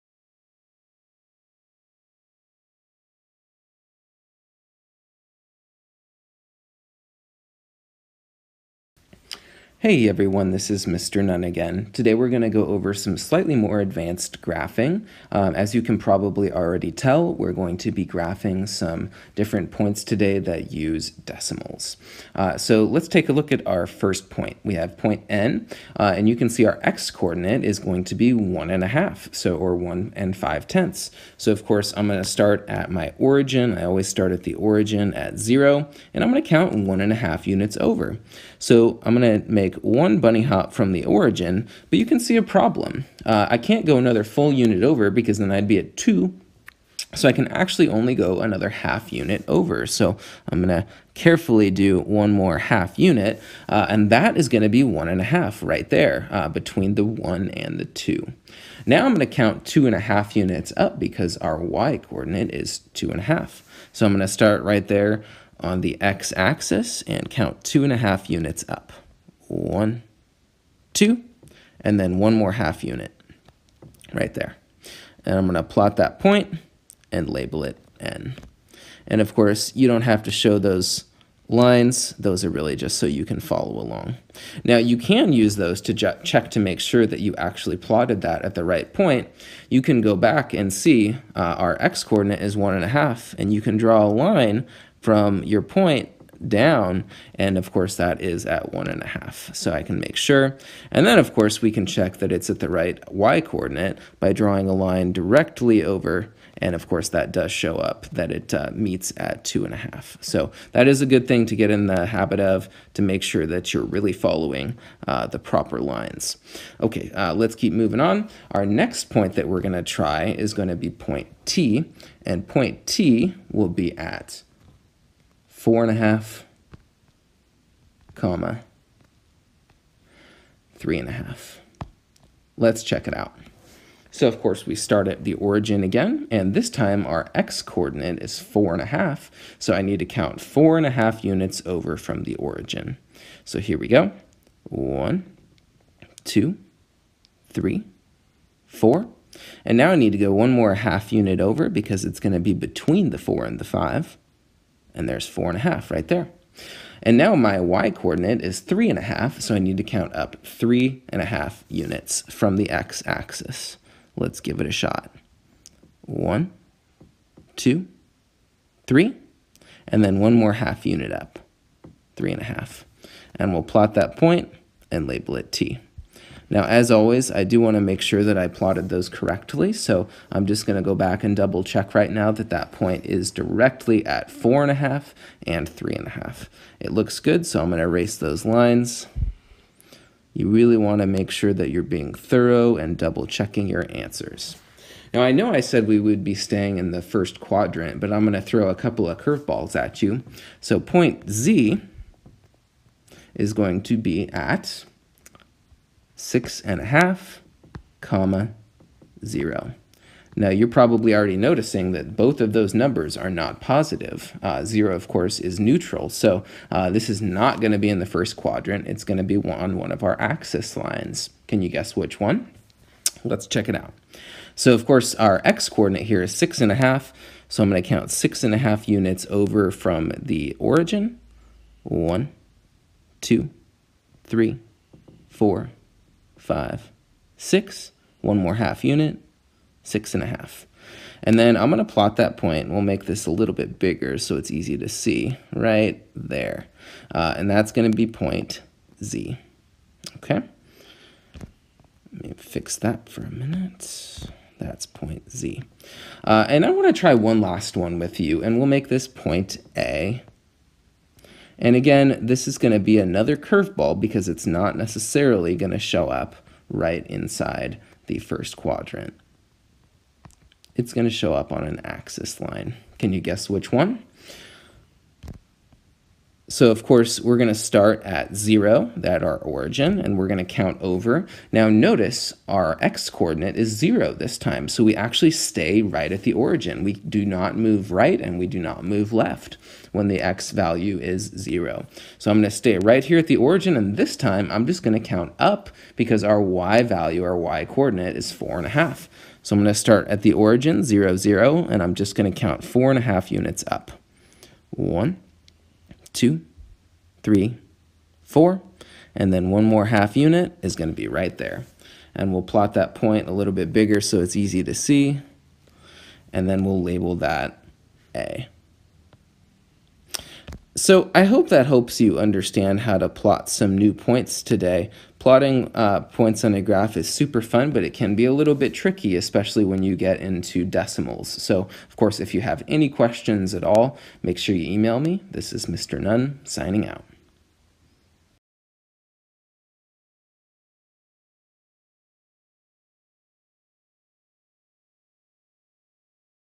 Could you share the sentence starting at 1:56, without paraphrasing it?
Okay, uh, let's keep moving on.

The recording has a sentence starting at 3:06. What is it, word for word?
It looks good, so I'm going to erase those lines.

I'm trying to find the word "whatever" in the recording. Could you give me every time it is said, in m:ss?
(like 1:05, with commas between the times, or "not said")
not said.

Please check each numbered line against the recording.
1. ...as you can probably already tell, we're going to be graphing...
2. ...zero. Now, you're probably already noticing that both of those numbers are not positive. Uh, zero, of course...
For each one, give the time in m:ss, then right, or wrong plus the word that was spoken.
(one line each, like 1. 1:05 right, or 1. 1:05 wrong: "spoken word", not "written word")
1. 0:15 right
2. 3:29 right.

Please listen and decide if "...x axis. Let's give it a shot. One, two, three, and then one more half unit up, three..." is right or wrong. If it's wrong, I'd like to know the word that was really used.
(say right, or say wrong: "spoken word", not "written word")
right.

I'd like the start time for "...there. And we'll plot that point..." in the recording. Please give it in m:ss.
5:11.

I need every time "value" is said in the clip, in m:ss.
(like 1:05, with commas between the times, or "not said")
4:50, 4:56.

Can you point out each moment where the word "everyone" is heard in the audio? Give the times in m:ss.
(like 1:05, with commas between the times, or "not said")
0:10.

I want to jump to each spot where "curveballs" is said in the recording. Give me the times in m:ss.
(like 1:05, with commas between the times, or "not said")
3:19, 4:23.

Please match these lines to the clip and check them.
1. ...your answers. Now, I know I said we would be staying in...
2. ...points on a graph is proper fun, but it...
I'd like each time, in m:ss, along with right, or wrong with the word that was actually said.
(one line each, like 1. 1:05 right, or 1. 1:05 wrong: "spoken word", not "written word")
1. 3:13 right
2. 5:26 wrong: "super", not "proper".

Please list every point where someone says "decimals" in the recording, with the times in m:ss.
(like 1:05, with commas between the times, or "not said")
0:21, 5:30.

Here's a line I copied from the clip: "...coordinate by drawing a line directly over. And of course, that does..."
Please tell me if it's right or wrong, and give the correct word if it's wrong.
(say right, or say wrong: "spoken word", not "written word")
right.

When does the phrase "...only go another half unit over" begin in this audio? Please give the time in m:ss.
0:47.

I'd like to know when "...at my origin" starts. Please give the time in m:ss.
0:32.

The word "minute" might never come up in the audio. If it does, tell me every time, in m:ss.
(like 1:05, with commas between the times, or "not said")
4:13.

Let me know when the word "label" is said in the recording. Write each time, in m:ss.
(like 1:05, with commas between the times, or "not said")
1:17, 2:55, 5:16.